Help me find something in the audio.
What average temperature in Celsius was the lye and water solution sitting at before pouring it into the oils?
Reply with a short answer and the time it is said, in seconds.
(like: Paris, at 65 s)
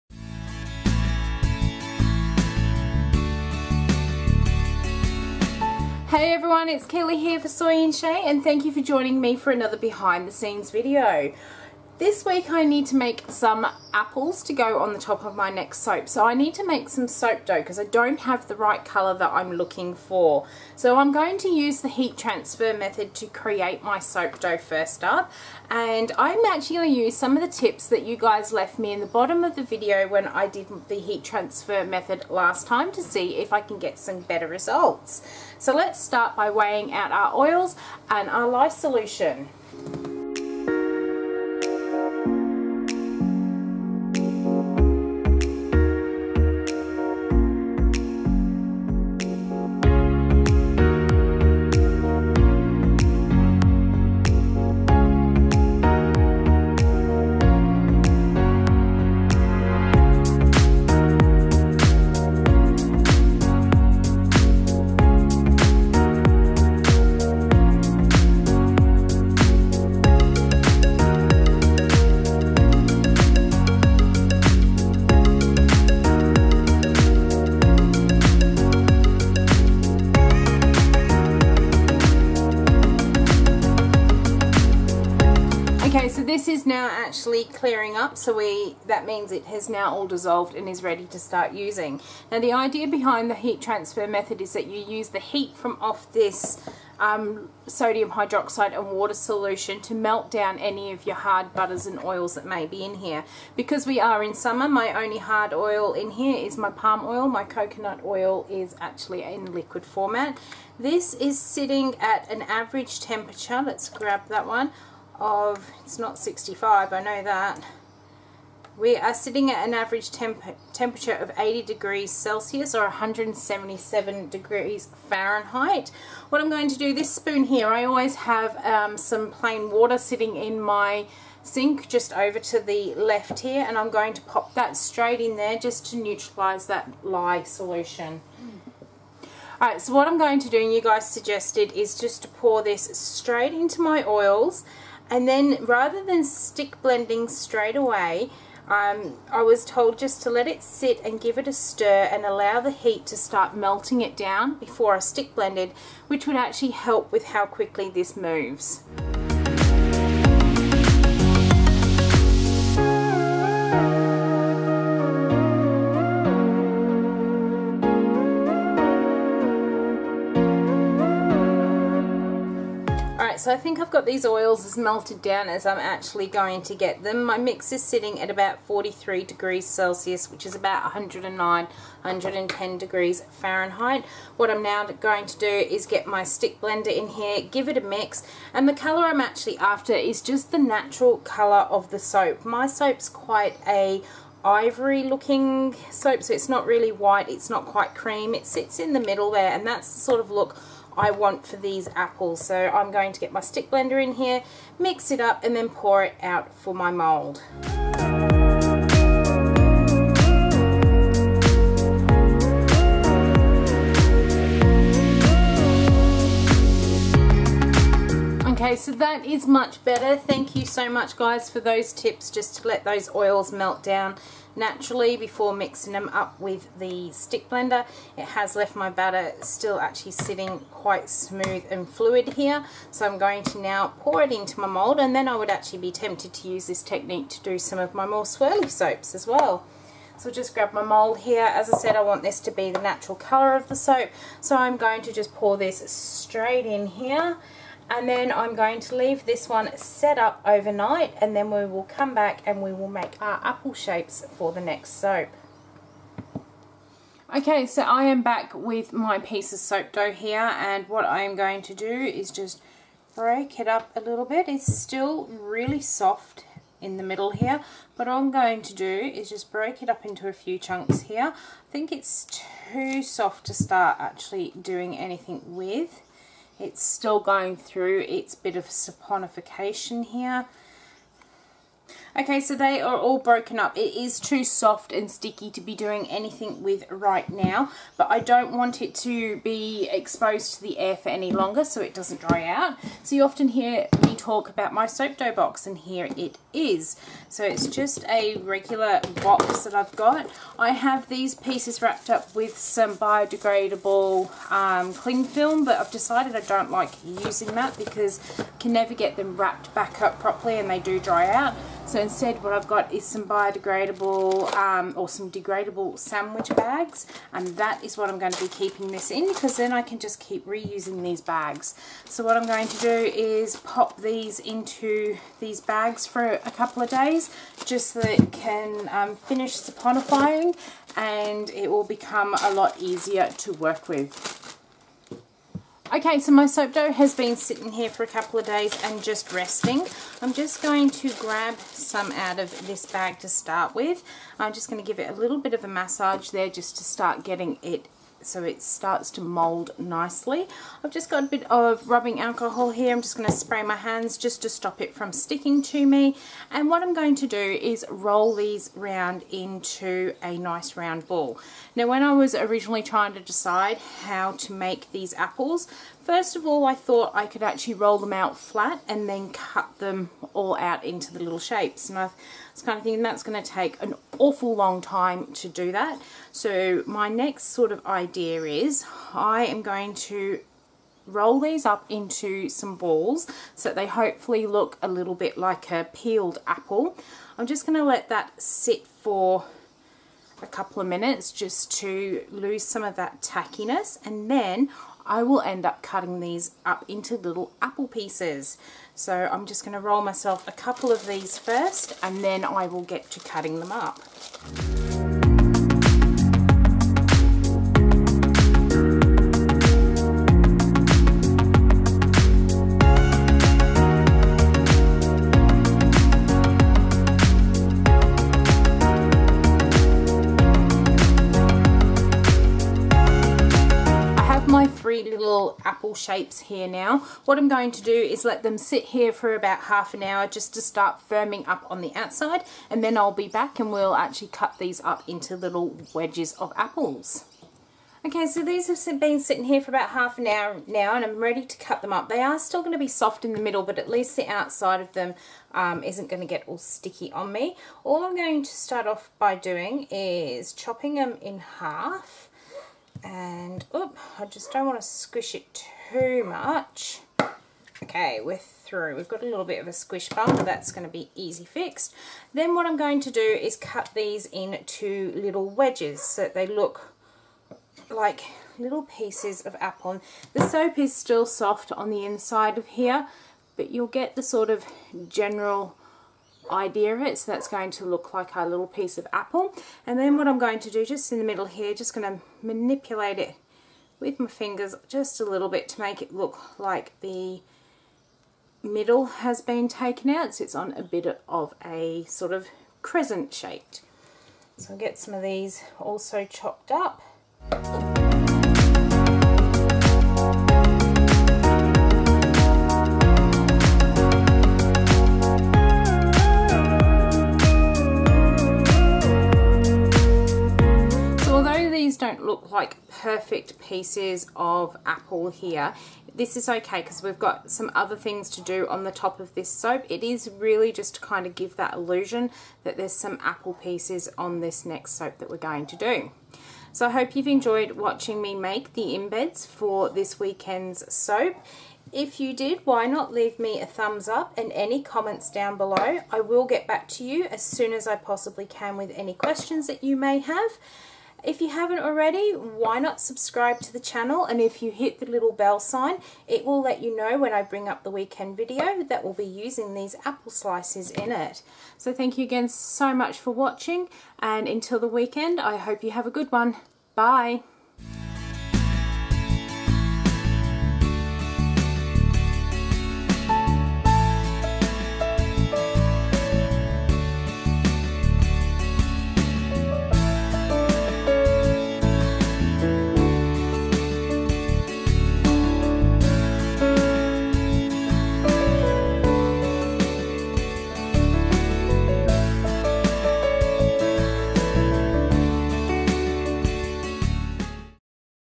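80 degrees Celsius, at 121 s.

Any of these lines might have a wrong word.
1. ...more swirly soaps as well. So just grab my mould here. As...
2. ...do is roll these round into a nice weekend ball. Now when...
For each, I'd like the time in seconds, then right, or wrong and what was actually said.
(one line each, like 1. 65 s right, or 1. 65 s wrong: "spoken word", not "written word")
1. 238 s right
2. 357 s wrong: "round", not "weekend".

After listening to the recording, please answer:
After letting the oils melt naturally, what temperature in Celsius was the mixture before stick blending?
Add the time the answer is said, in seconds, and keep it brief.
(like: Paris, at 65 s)
43 degrees Celsius, at 178 s.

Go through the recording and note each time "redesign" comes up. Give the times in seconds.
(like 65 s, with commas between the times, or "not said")
not said.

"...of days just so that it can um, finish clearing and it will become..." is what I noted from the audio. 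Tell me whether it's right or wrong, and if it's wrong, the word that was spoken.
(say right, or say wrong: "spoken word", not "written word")
wrong: "saponifying", not "clearing".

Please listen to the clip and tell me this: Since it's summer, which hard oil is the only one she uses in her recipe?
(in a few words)
Palm oil.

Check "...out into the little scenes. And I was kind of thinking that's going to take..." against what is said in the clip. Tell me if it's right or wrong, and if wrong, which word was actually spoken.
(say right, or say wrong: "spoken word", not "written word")
wrong: "shapes", not "scenes".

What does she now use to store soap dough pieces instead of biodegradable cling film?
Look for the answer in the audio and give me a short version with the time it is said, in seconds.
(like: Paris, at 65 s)
Sandwich bags, at 315 s.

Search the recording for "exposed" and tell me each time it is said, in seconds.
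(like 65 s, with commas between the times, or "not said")
289 s.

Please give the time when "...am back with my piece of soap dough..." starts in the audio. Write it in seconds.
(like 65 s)
258 s.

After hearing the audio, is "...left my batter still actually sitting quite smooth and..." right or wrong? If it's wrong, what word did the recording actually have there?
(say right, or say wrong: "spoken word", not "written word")
right.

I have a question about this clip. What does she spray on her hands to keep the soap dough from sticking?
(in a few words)
Rubbing alcohol.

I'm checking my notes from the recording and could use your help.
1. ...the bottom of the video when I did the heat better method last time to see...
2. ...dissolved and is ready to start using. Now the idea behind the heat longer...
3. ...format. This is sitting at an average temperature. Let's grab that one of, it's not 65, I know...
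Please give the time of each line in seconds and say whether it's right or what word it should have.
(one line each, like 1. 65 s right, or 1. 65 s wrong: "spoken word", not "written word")
1. 28 s wrong: "transfer", not "better"
2. 90 s wrong: "transfer", not "longer"
3. 109 s right.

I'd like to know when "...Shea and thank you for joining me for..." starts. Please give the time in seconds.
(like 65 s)
7 s.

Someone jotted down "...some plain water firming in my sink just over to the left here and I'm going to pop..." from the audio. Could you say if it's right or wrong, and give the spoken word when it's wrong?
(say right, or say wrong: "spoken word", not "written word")
wrong: "sitting", not "firming".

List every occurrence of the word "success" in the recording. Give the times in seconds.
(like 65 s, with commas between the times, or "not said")
not said.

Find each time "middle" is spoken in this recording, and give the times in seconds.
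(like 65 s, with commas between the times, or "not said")
198 s, 267 s, 443 s, 481 s, 488 s.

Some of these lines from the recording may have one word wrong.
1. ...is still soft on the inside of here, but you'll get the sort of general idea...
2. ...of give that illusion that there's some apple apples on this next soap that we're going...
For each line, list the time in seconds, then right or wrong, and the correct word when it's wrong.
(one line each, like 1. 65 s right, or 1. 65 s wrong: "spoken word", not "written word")
1. 470 s right
2. 521 s wrong: "pieces", not "apples".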